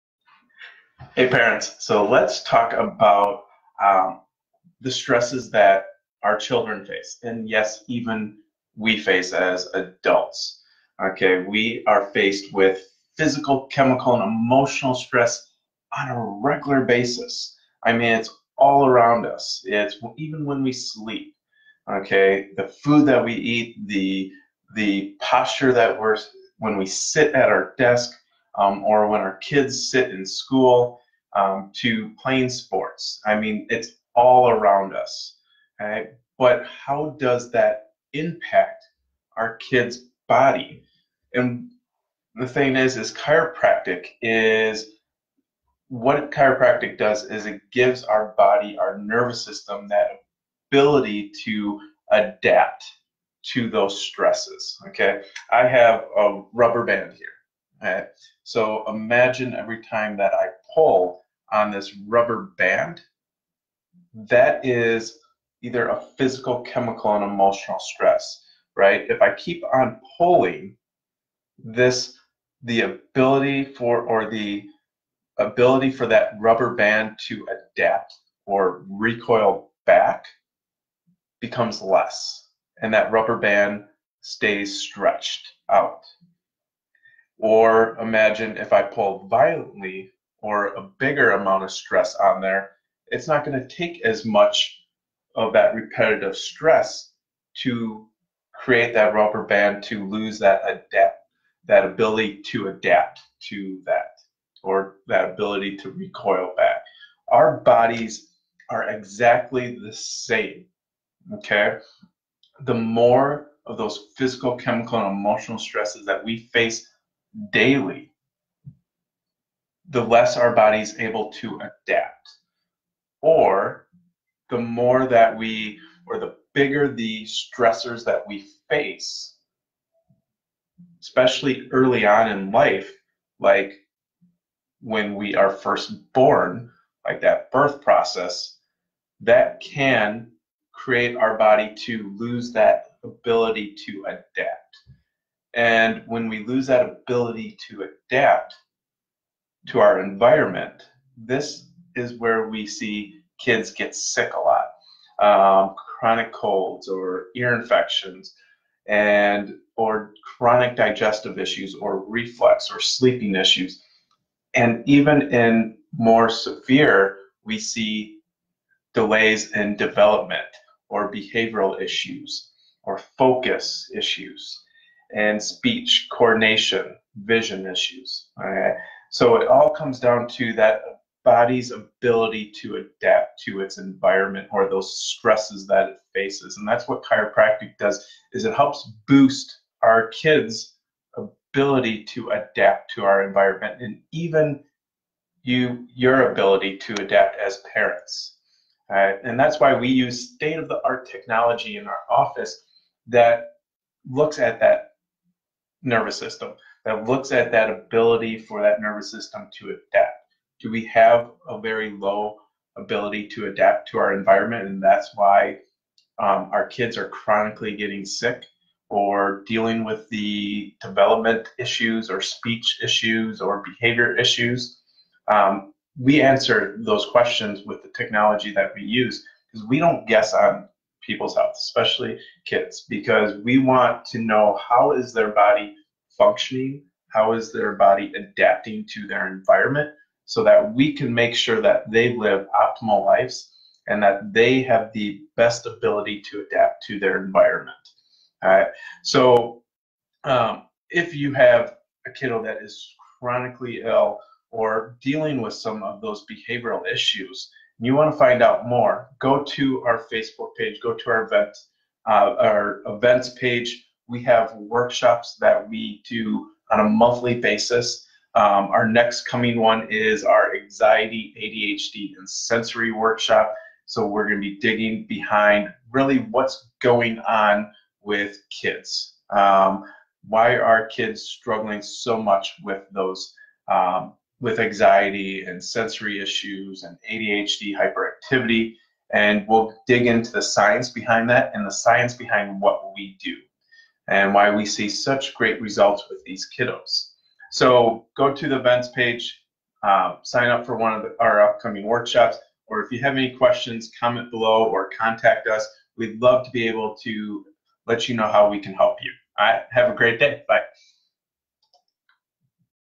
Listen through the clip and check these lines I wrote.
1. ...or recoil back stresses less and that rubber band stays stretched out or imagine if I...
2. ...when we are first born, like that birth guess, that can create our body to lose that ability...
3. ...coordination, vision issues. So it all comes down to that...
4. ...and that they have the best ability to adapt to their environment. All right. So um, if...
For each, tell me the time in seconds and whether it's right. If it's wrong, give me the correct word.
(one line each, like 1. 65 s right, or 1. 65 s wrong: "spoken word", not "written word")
1. 78 s wrong: "becomes", not "stresses"
2. 134 s wrong: "process", not "guess"
3. 176 s right
4. 243 s right.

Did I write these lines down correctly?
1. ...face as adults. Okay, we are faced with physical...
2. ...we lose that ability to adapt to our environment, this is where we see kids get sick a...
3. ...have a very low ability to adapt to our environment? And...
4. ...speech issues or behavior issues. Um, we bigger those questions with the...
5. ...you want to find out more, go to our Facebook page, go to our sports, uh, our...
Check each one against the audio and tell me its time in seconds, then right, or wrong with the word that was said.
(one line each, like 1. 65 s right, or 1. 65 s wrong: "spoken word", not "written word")
1. 8 s right
2. 146 s right
3. 210 s right
4. 222 s wrong: "answer", not "bigger"
5. 257 s wrong: "events", not "sports".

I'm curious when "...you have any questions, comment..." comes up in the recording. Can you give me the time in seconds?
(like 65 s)
302 s.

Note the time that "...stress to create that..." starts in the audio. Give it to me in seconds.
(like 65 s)
96 s.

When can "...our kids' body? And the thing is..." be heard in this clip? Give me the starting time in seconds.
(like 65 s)
39 s.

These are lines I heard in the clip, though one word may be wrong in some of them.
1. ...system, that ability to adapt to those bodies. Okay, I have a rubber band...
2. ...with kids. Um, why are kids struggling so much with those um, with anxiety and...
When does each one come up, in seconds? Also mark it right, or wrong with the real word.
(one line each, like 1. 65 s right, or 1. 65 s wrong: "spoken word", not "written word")
1. 49 s wrong: "stresses", not "bodies"
2. 278 s right.